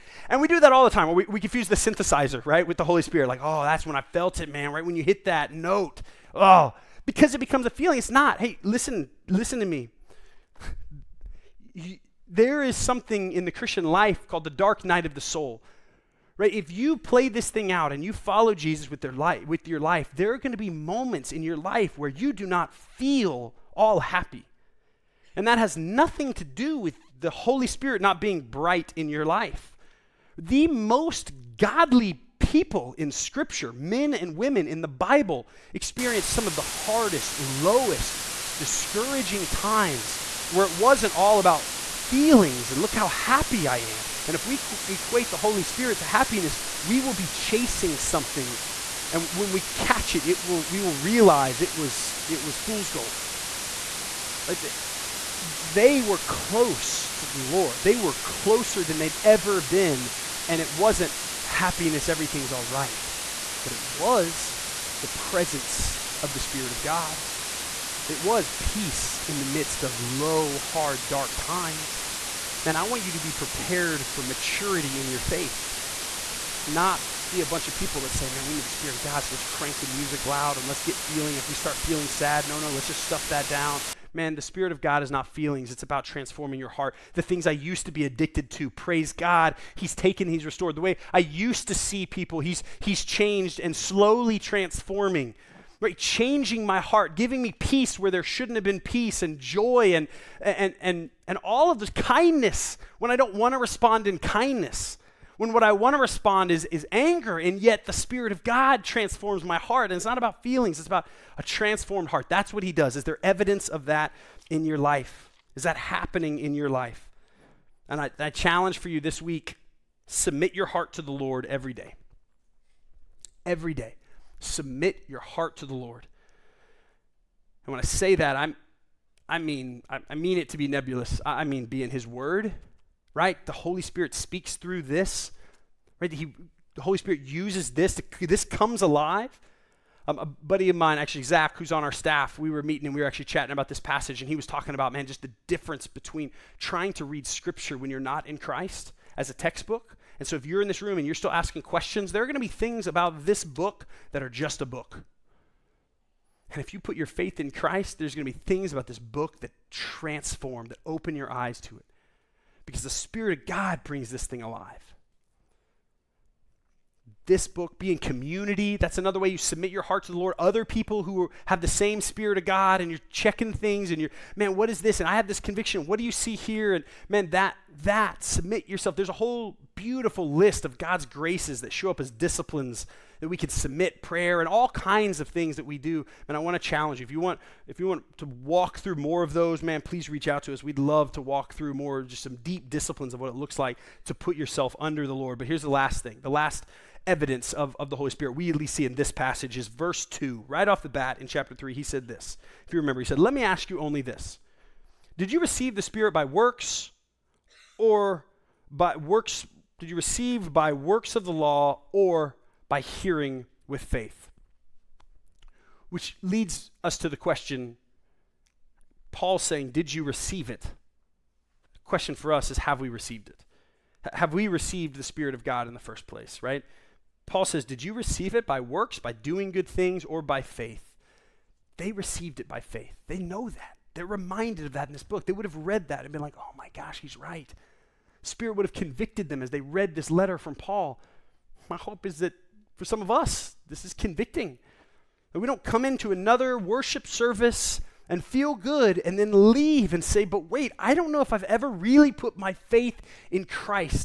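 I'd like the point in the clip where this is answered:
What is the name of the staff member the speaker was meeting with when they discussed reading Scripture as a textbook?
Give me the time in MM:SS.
02:21.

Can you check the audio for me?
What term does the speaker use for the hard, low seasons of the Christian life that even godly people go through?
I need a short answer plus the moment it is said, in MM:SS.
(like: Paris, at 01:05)
dark night of the soul, at 00:14.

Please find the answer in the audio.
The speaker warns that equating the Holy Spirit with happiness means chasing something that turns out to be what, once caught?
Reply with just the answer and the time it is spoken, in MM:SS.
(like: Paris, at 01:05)
fool's gold, at 00:52.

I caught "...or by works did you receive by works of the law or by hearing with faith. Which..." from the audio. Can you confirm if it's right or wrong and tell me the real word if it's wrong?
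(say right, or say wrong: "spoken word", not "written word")
right.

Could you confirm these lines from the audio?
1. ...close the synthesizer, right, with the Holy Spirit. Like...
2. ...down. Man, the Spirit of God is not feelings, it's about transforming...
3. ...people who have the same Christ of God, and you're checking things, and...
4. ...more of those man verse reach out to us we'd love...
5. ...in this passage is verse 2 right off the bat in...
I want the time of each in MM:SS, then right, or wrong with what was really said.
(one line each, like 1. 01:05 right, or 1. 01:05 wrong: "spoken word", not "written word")
1. 00:01 wrong: "confuse", not "close"
2. 01:23 right
3. 02:50 wrong: "Spirit", not "Christ"
4. 03:08 wrong: "please", not "verse"
5. 03:18 right.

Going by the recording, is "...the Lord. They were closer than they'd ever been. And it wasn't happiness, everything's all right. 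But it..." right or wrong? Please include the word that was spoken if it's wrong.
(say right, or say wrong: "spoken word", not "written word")
right.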